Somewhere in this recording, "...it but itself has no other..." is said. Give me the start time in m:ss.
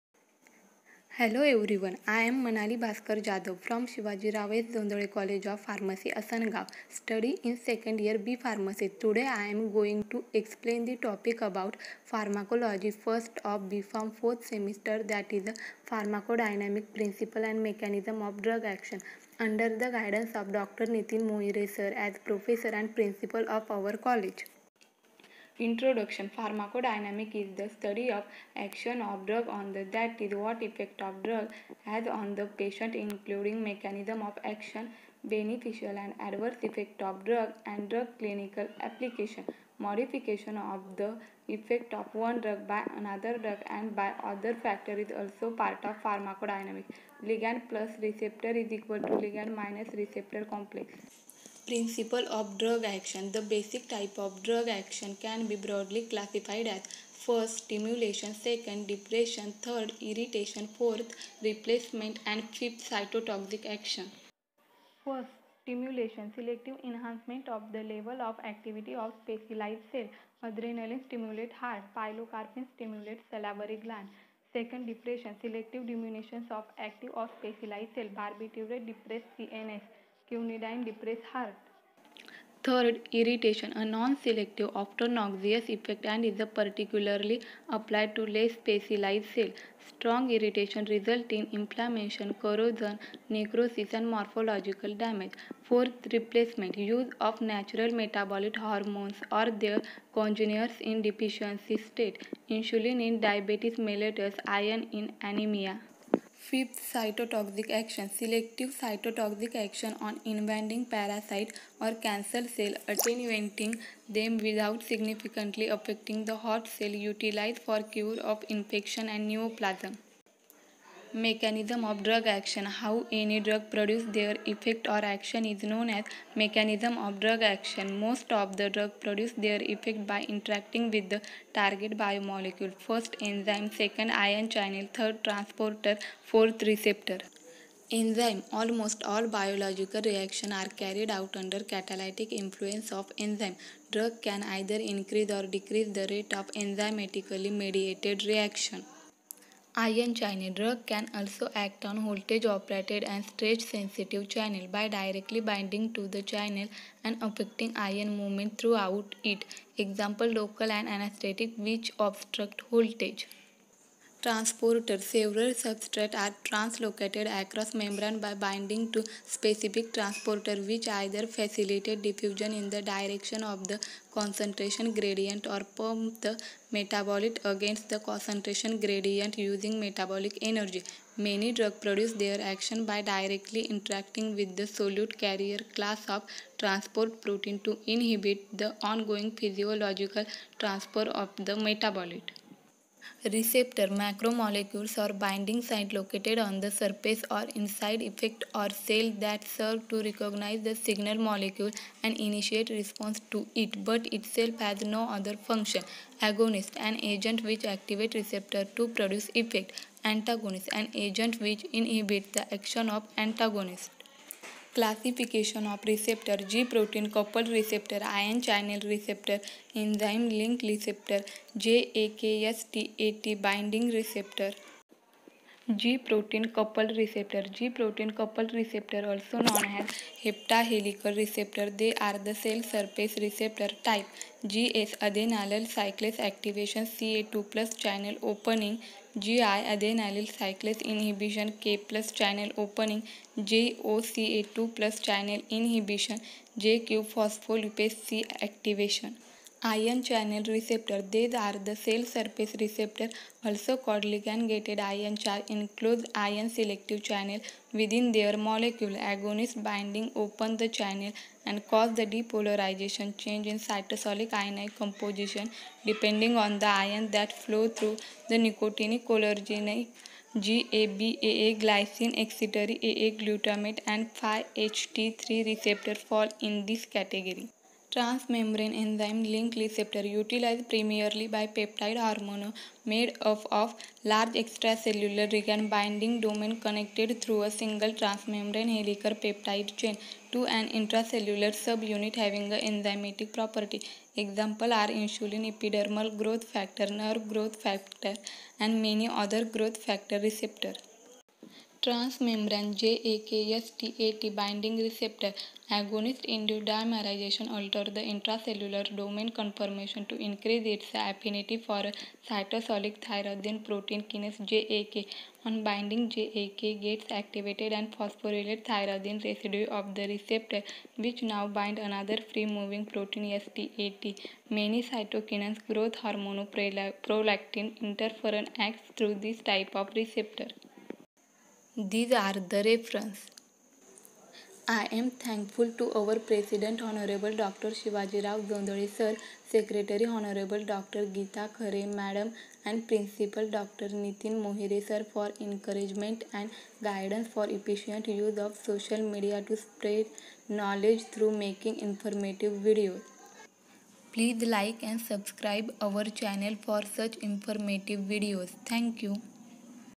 3:23.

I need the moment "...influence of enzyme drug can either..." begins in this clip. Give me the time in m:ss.
2:22.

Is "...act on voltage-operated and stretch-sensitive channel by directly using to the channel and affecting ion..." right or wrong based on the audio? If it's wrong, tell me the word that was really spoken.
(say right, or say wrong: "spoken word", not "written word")
wrong: "binding", not "using".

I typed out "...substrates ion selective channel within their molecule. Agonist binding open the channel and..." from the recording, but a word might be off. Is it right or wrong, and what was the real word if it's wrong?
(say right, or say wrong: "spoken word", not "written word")
wrong: "includes", not "substrates".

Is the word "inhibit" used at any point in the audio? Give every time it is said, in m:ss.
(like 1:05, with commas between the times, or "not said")
3:07, 3:31.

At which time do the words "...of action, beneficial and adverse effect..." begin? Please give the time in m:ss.
0:34.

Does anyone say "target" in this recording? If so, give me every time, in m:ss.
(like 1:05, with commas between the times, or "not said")
2:11.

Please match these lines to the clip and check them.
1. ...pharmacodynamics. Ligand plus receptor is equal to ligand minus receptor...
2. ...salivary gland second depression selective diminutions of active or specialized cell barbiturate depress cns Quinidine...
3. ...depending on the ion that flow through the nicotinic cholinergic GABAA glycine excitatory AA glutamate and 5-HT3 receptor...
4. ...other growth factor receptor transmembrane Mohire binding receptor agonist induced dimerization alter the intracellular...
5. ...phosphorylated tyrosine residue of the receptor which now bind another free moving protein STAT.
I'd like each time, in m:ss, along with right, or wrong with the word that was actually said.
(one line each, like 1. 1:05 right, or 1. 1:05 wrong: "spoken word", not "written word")
1. 0:46 right
2. 1:13 right
3. 4:25 right
4. 4:59 wrong: "JAKSTAT", not "Mohire"
5. 5:17 right.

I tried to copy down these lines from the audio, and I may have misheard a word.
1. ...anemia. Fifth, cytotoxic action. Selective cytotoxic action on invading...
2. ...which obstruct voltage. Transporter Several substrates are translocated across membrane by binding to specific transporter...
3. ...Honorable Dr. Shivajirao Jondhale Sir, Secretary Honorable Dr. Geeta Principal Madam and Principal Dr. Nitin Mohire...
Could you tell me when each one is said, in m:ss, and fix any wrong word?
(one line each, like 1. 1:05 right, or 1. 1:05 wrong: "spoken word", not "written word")
1. 1:45 right
2. 2:41 right
3. 5:36 wrong: "Khare", not "Principal".